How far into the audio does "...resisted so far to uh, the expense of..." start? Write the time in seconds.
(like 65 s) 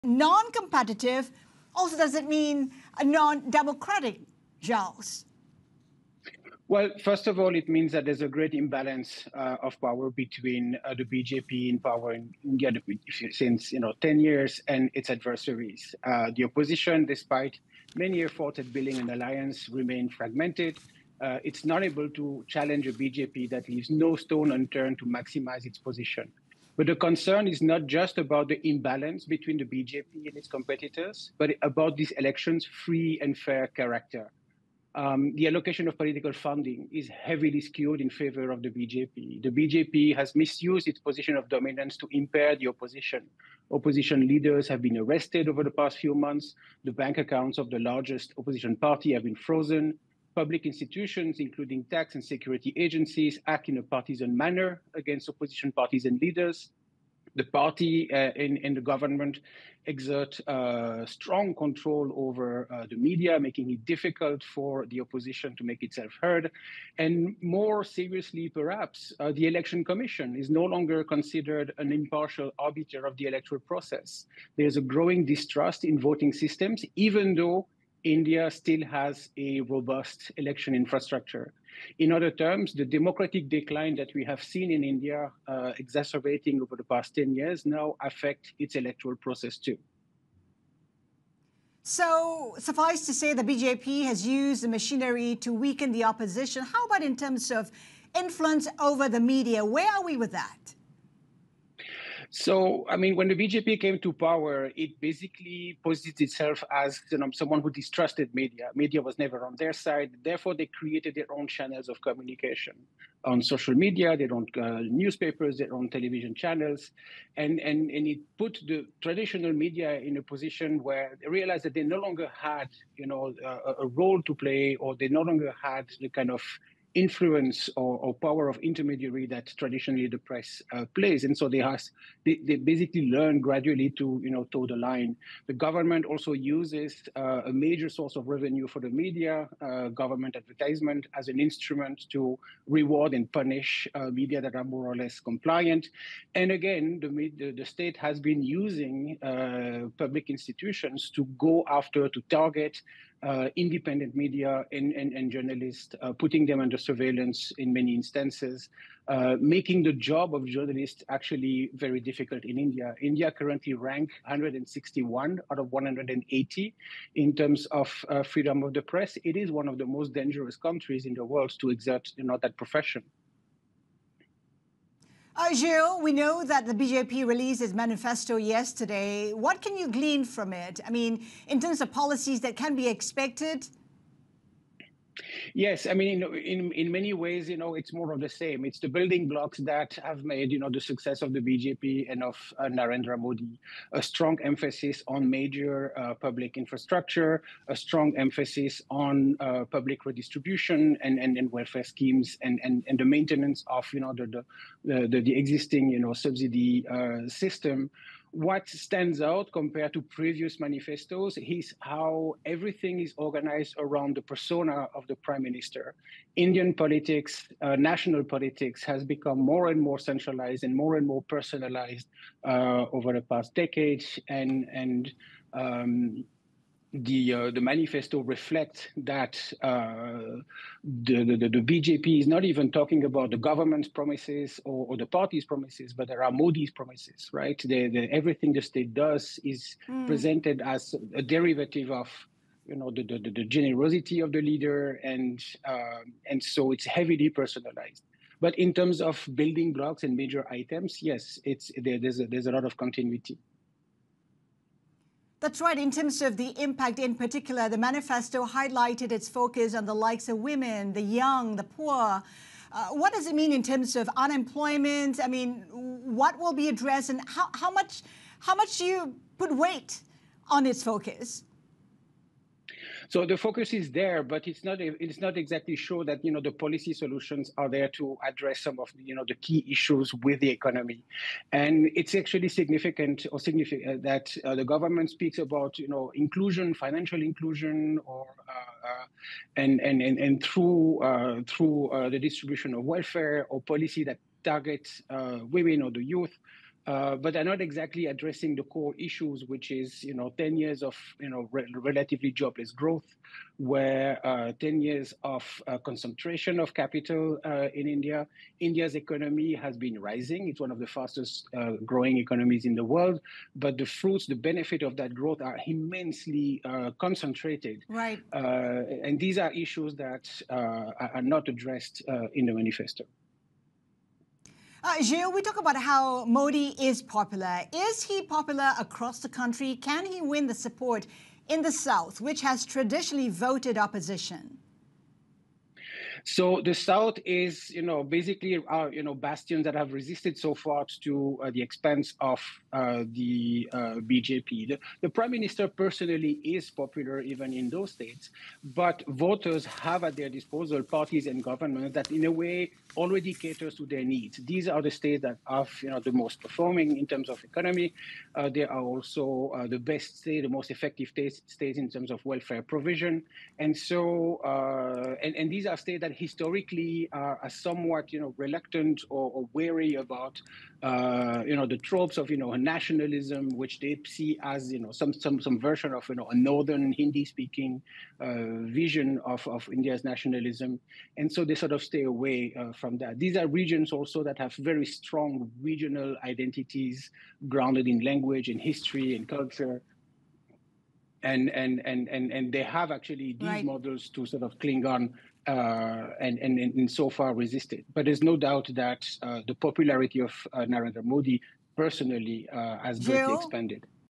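339 s.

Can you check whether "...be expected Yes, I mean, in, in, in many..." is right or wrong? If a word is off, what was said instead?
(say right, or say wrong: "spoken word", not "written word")
right.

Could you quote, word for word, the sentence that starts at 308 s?
India's economy has been rising; it's one of the fastest uh, growing economies in the world.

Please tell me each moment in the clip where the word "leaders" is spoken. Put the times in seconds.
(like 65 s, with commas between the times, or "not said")
44 s, 56 s, 244 s.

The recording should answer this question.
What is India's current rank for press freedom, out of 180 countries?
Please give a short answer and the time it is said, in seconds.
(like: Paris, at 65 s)
161, at 164 s.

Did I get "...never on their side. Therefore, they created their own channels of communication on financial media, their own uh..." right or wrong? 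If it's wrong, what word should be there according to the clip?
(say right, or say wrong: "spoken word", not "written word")
wrong: "social", not "financial".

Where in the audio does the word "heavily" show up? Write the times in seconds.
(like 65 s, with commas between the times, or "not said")
37 s, 246 s.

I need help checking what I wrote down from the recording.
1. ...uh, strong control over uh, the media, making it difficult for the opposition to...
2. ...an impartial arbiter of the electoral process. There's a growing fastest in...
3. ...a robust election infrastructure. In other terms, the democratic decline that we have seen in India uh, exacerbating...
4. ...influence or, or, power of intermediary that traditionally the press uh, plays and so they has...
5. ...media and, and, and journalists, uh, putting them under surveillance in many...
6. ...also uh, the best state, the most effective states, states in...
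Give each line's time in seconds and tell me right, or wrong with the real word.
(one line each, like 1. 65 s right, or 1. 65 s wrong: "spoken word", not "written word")
1. 60 s right
2. 71 s wrong: "distrust", not "fastest"
3. 79 s right
4. 126 s right
5. 154 s right
6. 358 s right.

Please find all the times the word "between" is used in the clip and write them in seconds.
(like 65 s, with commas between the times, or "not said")
10 s, 29 s.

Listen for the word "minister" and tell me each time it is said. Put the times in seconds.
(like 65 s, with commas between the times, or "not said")
215 s, 345 s.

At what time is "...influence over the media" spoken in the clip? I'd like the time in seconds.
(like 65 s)
98 s.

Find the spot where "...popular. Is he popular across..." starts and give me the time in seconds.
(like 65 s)
327 s.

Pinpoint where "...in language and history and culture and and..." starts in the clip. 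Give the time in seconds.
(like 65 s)
387 s.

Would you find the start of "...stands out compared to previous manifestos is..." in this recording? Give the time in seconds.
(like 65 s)
208 s.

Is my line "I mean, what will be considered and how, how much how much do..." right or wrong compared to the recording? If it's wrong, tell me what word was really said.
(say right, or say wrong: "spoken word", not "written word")
wrong: "addressed", not "considered".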